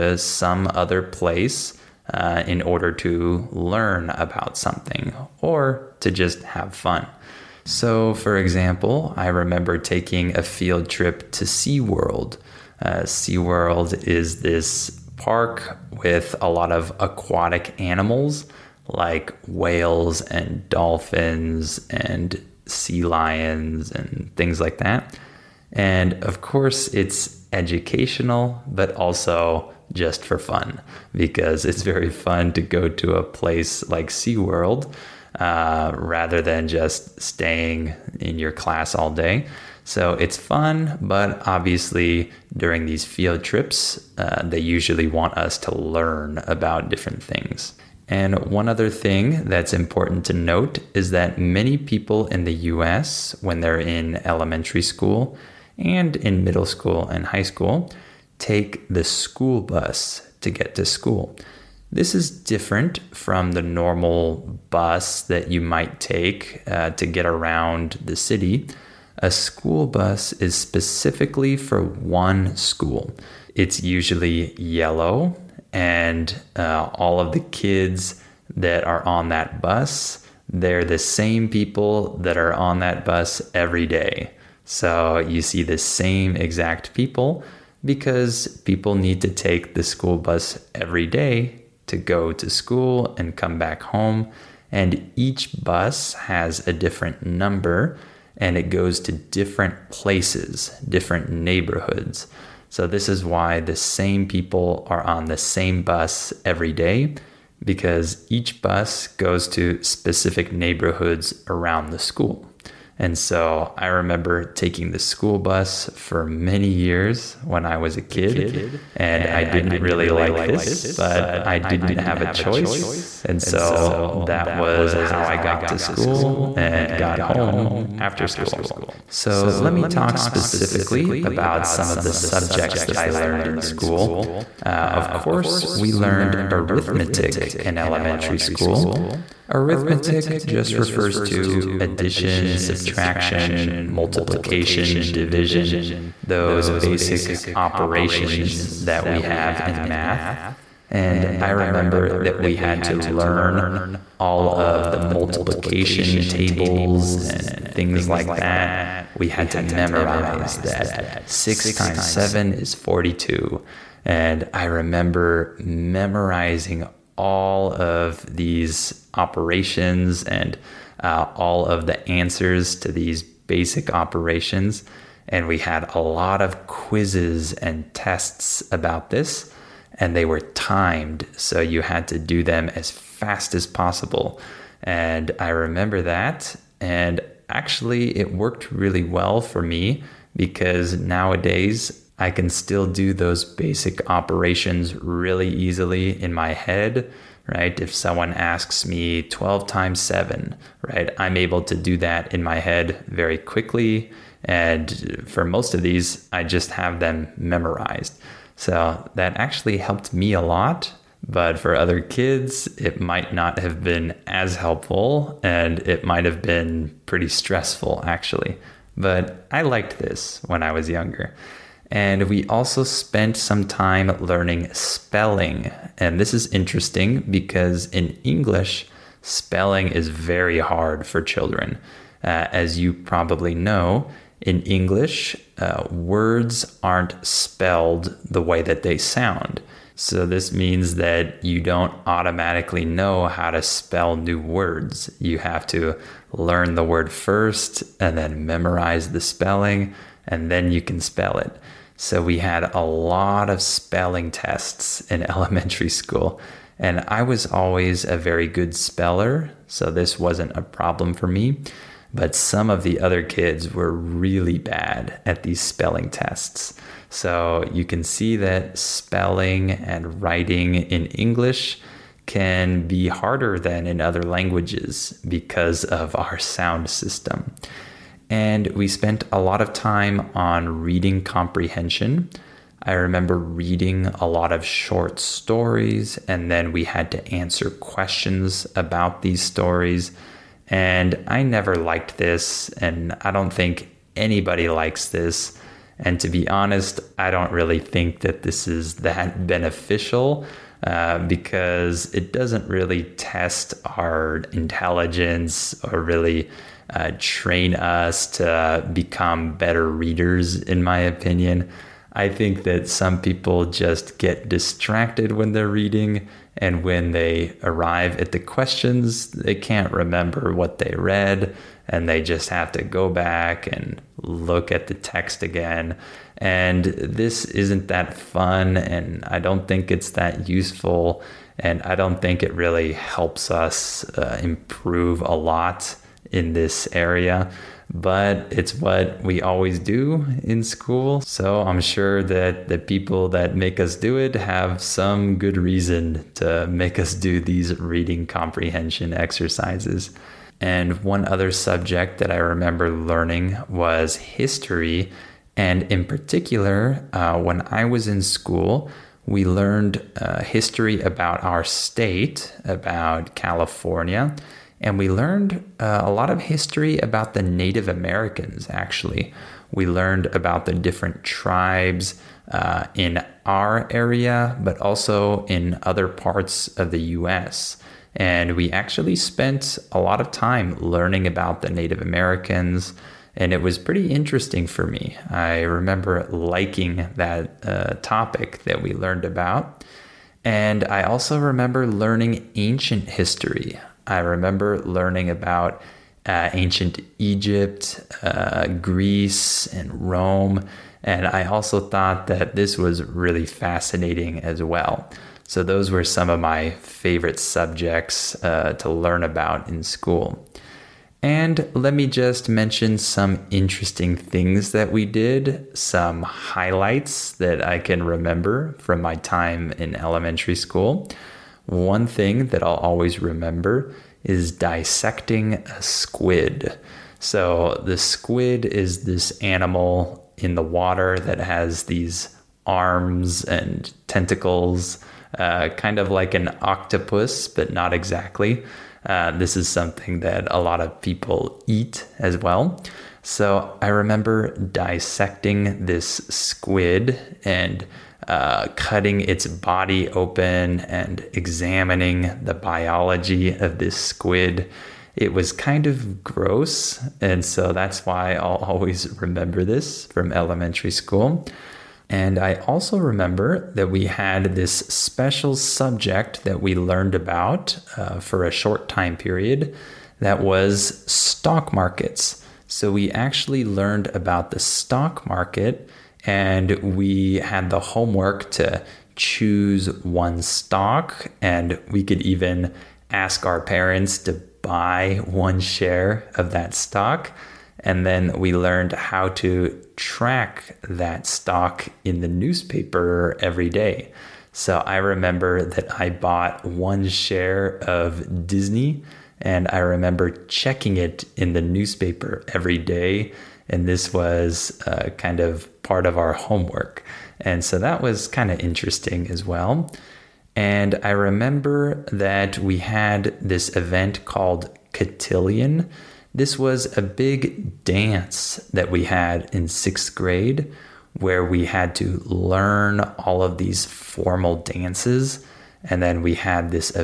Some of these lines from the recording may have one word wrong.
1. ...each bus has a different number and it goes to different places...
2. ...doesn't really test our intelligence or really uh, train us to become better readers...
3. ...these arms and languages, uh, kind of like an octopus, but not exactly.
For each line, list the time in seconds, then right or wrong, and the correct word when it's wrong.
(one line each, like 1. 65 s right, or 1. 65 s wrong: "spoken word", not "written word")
1. 95 s right
2. 302 s right
3. 431 s wrong: "tentacles", not "languages".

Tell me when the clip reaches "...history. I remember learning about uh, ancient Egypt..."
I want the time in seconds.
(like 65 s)
393 s.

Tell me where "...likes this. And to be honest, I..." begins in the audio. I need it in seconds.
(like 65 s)
294 s.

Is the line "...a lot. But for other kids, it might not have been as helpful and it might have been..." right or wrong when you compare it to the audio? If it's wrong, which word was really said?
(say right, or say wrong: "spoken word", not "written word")
right.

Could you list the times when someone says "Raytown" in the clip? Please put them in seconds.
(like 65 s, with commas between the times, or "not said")
not said.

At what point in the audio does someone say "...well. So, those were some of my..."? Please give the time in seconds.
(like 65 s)
404 s.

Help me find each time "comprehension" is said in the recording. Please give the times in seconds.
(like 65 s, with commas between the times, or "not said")
281 s, 348 s.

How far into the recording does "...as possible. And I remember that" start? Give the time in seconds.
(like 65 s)
183 s.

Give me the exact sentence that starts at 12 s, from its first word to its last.
Uh, SeaWorld is this park with a lot of aquatic animals like whales and dolphins and sea lions and things like that.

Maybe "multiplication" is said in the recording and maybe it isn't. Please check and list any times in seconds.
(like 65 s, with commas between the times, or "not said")
143 s, 154 s.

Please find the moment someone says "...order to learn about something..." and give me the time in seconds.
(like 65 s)
2 s.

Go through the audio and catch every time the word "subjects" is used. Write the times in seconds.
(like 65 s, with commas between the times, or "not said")
132 s, 351 s, 407 s, 465 s.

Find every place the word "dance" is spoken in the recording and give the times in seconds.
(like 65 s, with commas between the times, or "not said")
517 s, 524 s.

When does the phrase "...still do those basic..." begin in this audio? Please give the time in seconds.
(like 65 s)
192 s.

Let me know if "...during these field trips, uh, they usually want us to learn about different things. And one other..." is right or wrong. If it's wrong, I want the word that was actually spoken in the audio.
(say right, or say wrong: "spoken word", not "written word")
right.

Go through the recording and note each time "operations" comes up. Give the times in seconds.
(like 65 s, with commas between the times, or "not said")
147 s, 169 s, 173 s, 194 s.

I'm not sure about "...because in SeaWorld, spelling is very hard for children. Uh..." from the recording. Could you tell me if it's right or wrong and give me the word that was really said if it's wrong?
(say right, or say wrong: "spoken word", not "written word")
wrong: "English", not "SeaWorld".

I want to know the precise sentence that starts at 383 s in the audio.
And it was pretty interesting for me.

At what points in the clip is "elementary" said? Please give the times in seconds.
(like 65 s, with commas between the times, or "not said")
54 s, 137 s, 255 s, 419 s, 460 s.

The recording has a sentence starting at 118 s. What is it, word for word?
And I didn't really like this, but I didn't have a choice.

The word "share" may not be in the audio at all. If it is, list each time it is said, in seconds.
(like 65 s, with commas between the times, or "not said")
485 s, 497 s.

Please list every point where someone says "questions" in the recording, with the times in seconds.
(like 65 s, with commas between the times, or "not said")
287 s, 318 s.